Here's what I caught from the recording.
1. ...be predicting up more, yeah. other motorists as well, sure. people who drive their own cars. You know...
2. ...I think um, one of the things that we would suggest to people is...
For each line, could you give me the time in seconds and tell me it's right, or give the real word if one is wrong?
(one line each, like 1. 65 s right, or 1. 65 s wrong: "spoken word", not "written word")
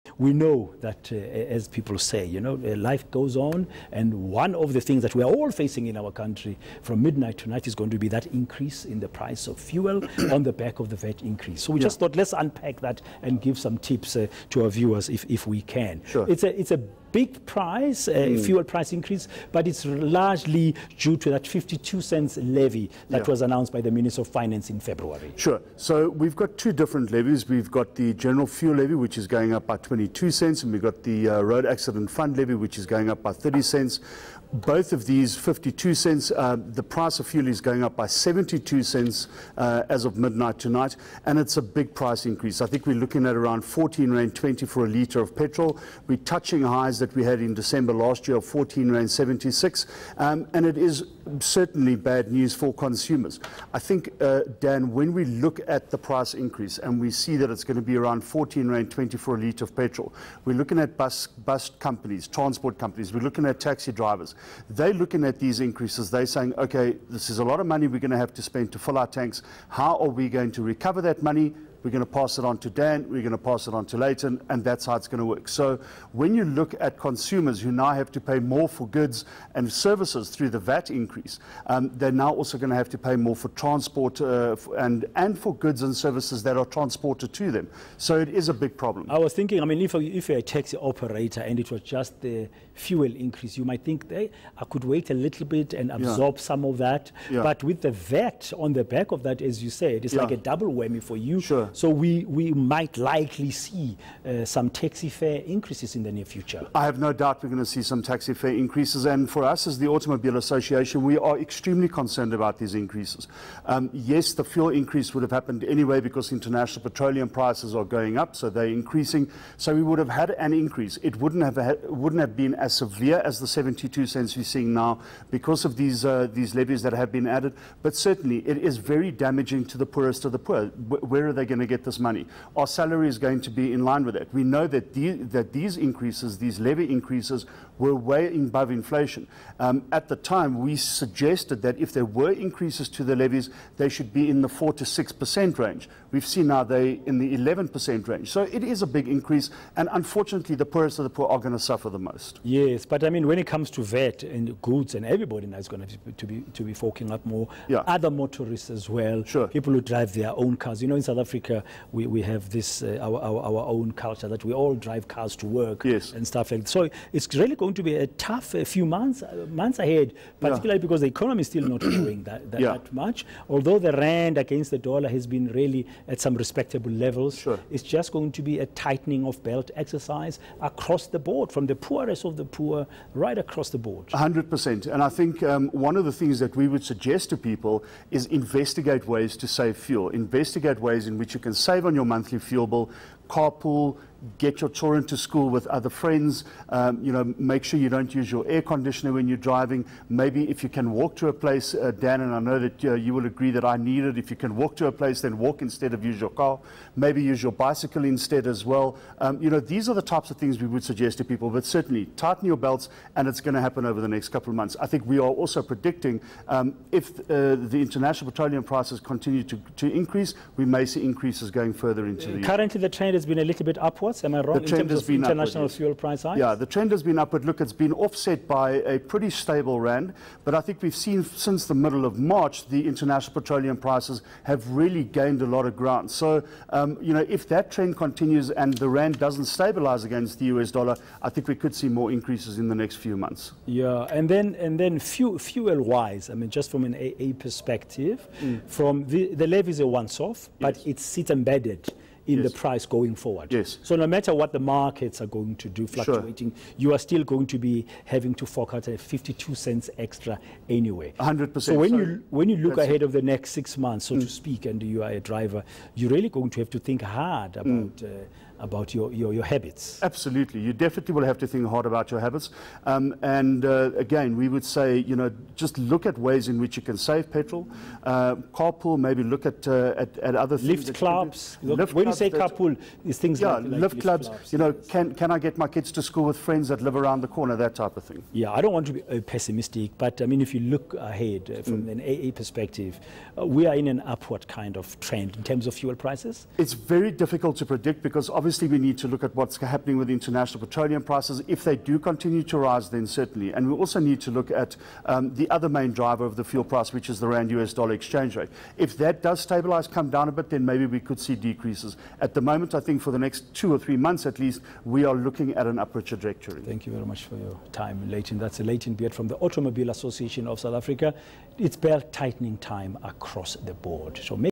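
1. 156 s wrong: "forking", not "predicting"
2. 185 s right.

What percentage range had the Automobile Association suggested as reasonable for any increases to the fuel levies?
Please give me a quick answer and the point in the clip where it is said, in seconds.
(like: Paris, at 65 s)
4 to 6%, at 144 s.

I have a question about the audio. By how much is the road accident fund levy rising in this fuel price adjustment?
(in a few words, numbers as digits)
30 cents.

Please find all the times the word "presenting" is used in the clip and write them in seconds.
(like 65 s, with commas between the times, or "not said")
not said.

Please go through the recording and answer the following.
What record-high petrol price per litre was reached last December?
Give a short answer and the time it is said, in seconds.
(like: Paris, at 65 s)
R14.76, at 48 s.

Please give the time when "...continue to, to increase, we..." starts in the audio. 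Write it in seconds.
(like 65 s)
218 s.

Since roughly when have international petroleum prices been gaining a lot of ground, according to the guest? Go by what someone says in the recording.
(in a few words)
middle of March.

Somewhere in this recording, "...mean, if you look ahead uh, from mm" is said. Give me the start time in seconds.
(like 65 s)
290 s.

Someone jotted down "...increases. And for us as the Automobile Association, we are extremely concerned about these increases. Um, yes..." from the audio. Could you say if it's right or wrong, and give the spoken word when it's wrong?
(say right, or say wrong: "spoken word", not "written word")
right.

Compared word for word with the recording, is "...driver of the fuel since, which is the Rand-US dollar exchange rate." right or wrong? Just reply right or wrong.
wrong.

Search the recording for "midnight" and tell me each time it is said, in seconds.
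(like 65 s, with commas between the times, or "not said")
7 s, 40 s.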